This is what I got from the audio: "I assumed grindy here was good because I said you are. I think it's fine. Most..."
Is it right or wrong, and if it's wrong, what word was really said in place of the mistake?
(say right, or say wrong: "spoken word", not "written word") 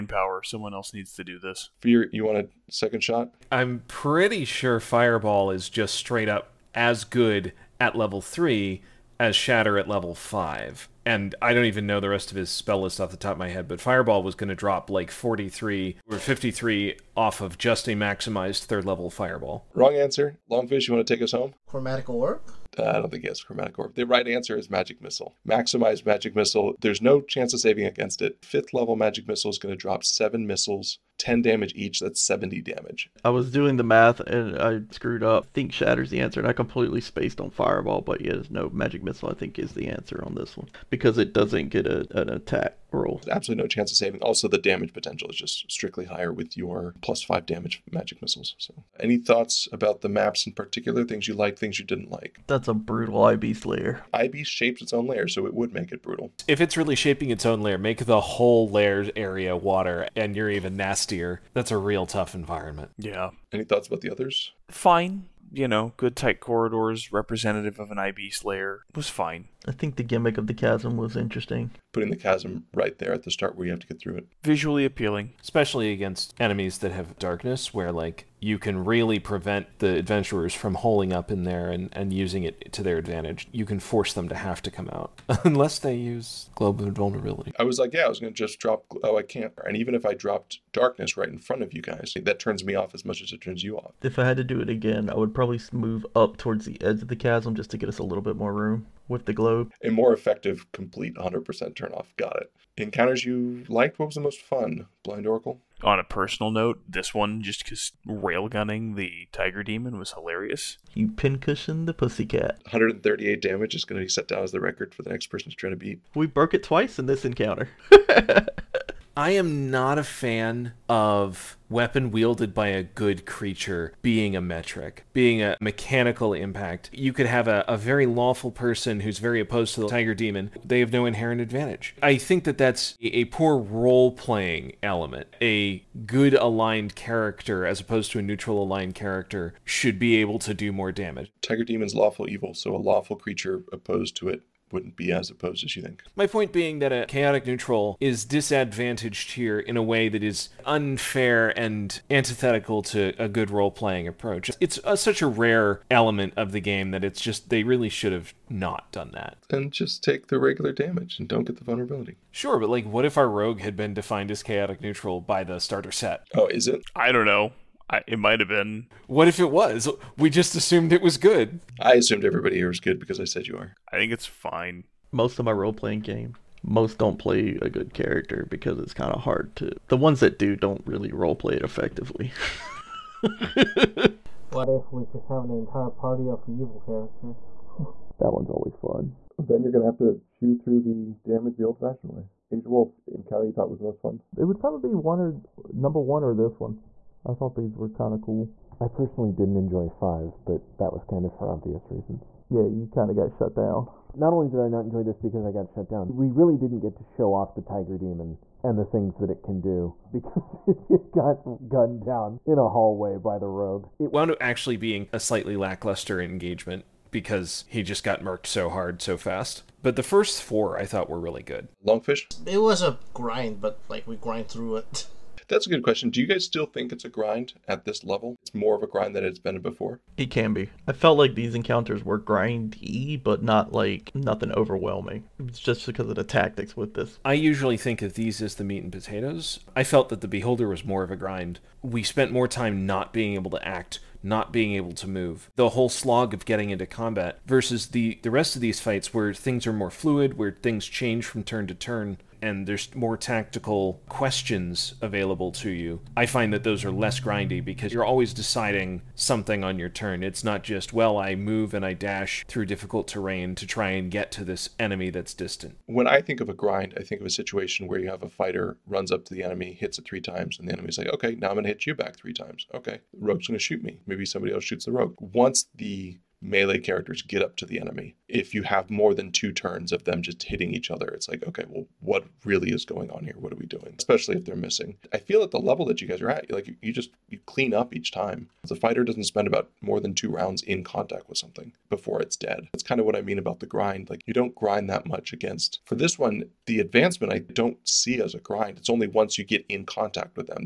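wrong: "everybody", not "grindy".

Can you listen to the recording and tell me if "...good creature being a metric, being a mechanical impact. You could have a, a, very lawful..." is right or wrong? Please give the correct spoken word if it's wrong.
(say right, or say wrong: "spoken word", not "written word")
right.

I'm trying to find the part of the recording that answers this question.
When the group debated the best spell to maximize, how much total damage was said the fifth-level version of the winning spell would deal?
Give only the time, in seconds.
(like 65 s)
32 s.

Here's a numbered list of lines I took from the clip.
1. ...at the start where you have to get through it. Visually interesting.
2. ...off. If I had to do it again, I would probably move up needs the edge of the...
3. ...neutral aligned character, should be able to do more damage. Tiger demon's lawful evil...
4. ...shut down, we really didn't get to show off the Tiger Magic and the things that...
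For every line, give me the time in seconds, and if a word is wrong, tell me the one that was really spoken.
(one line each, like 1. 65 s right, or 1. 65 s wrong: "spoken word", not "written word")
1. 73 s wrong: "appealing", not "interesting"
2. 93 s wrong: "towards", not "needs"
3. 138 s right
4. 205 s wrong: "Demon", not "Magic".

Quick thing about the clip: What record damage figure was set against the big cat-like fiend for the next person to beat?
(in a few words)
138.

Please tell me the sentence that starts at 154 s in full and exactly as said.
It's a, uh, such a rare element of the game that it's just they really should have not done that.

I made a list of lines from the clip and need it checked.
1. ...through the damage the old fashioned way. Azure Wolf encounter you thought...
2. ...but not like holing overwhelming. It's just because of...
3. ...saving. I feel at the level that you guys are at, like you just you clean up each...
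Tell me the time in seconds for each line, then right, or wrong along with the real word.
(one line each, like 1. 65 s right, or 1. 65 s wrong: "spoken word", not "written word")
1. 190 s right
2. 233 s wrong: "nothing", not "holing"
3. 284 s wrong: "missing", not "saving".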